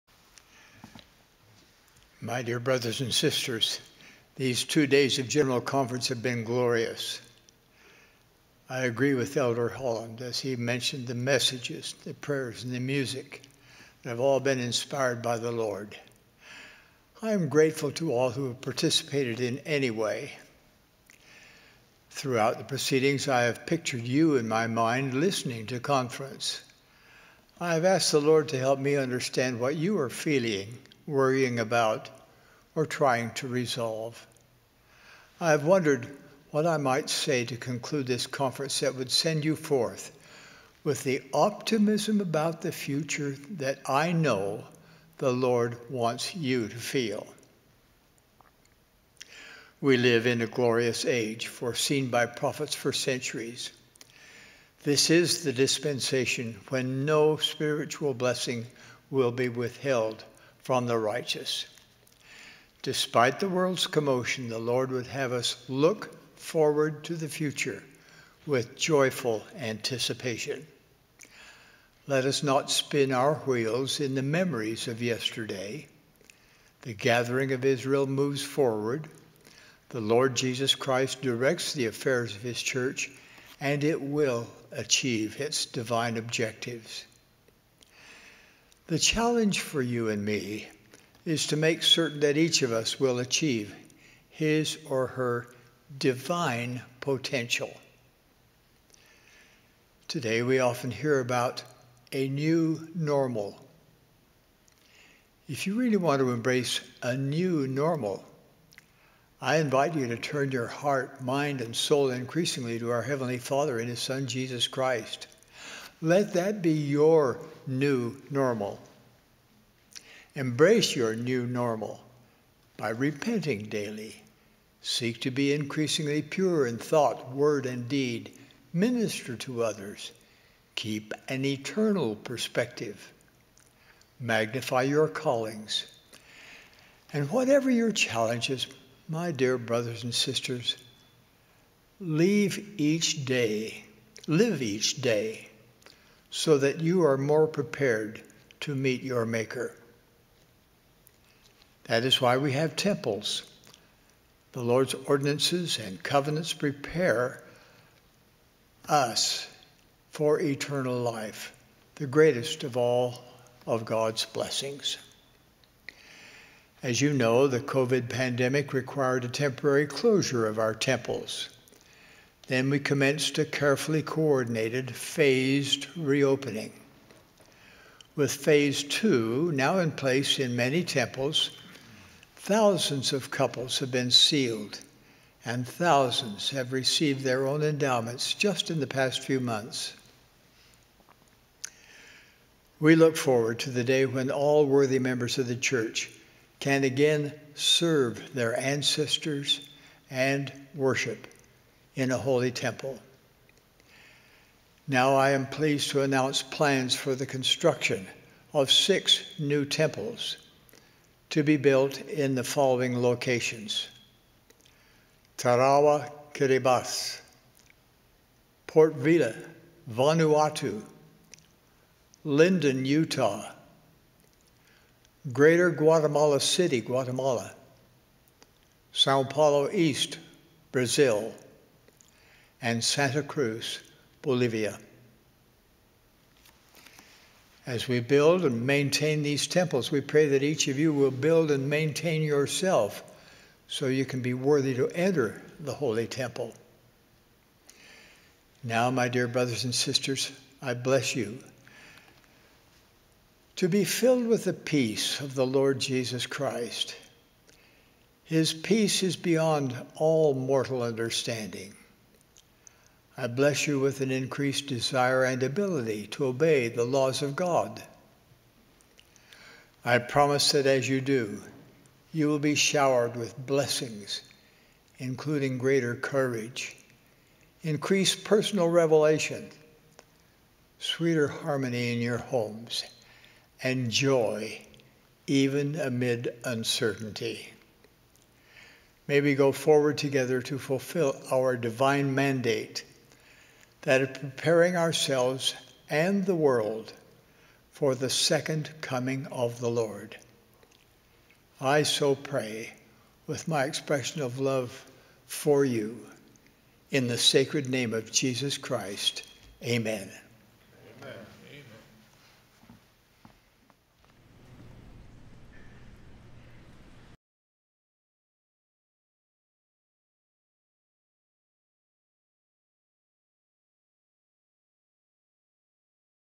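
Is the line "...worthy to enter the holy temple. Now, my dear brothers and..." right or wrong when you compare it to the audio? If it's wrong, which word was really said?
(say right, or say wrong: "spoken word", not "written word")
right.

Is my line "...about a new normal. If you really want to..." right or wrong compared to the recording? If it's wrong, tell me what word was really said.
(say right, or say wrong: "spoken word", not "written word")
right.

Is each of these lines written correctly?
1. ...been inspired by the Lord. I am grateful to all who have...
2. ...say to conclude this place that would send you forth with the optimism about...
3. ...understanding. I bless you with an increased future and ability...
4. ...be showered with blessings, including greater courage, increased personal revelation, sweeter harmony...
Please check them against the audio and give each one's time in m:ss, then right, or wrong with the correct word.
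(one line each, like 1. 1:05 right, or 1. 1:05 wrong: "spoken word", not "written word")
1. 0:14 right
2. 0:37 wrong: "conference", not "place"
3. 4:20 wrong: "desire", not "future"
4. 4:32 right.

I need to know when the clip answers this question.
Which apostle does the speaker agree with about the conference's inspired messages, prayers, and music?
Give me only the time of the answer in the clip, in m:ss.
0:09.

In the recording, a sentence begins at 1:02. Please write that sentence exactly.
Despite the world's commotion, the Lord would have us look forward to the future with joyful anticipation.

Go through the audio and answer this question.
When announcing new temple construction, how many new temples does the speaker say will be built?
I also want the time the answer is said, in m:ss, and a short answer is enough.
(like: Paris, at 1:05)
6, at 3:28.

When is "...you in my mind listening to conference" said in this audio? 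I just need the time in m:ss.
0:24.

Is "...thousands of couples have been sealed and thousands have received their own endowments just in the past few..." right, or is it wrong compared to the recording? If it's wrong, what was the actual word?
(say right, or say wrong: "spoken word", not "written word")
right.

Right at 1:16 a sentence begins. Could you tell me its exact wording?
The gathering of Israel moves forward.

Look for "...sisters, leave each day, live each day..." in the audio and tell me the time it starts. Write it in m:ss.
2:20.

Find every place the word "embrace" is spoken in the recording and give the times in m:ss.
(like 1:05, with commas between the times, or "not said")
1:46, 2:00.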